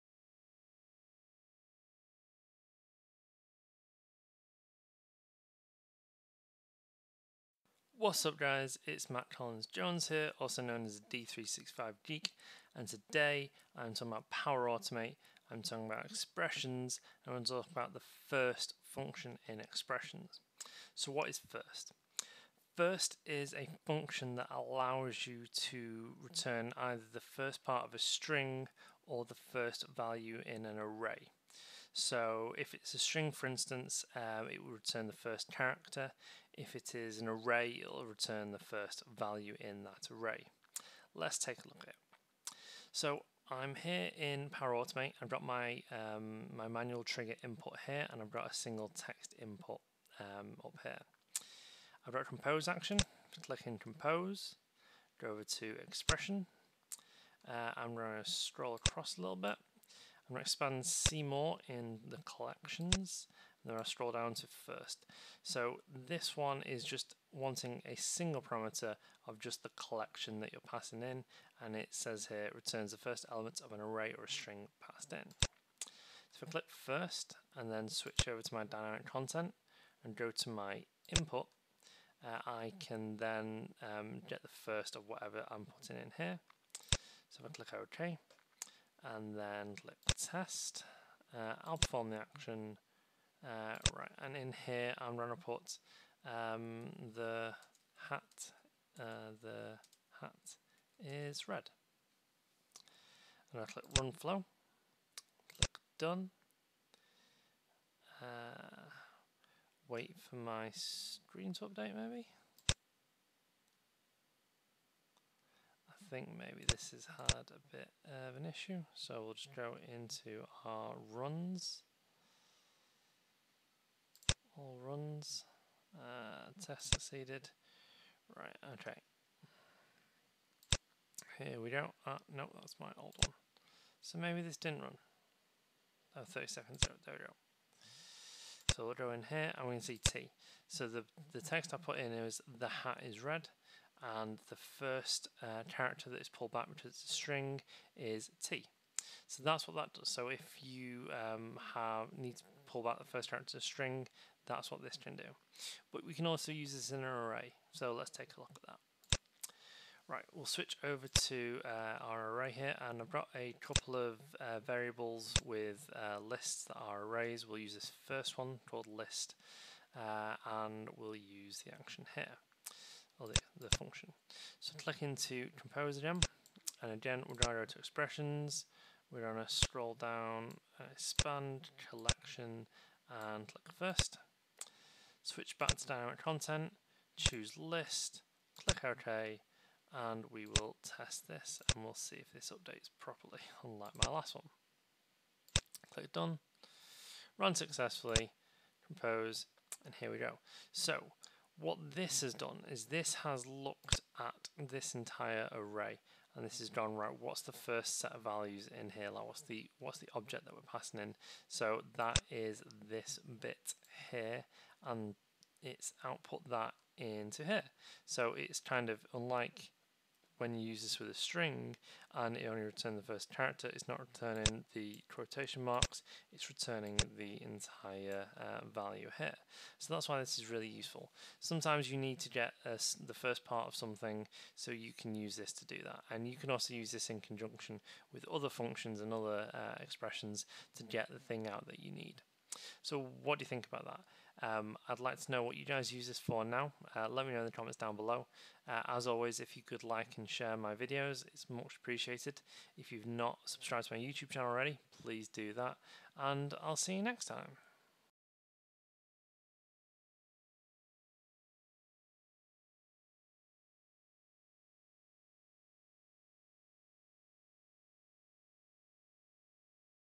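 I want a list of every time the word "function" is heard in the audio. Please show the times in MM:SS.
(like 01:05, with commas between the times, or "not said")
00:18, 00:23, 02:53, 03:58.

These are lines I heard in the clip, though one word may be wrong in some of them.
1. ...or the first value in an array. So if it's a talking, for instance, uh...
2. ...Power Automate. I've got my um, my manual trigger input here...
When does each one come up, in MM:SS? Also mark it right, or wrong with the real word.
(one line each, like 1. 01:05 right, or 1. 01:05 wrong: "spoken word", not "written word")
1. 00:29 wrong: "string", not "talking"
2. 00:44 right.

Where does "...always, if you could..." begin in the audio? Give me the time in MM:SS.
04:09.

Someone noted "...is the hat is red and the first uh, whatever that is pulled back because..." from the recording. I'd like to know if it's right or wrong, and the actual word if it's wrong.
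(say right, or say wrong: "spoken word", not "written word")
wrong: "character", not "whatever".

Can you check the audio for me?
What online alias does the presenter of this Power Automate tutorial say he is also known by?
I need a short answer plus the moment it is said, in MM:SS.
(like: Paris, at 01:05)
D365 Geek, at 00:11.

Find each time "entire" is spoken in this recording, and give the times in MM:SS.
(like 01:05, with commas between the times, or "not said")
03:24, 03:47.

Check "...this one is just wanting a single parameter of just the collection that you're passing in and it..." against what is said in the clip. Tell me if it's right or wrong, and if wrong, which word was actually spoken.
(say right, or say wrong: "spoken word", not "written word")
right.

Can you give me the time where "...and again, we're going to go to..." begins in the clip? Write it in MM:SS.
02:56.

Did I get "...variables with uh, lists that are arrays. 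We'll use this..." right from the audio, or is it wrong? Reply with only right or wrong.
right.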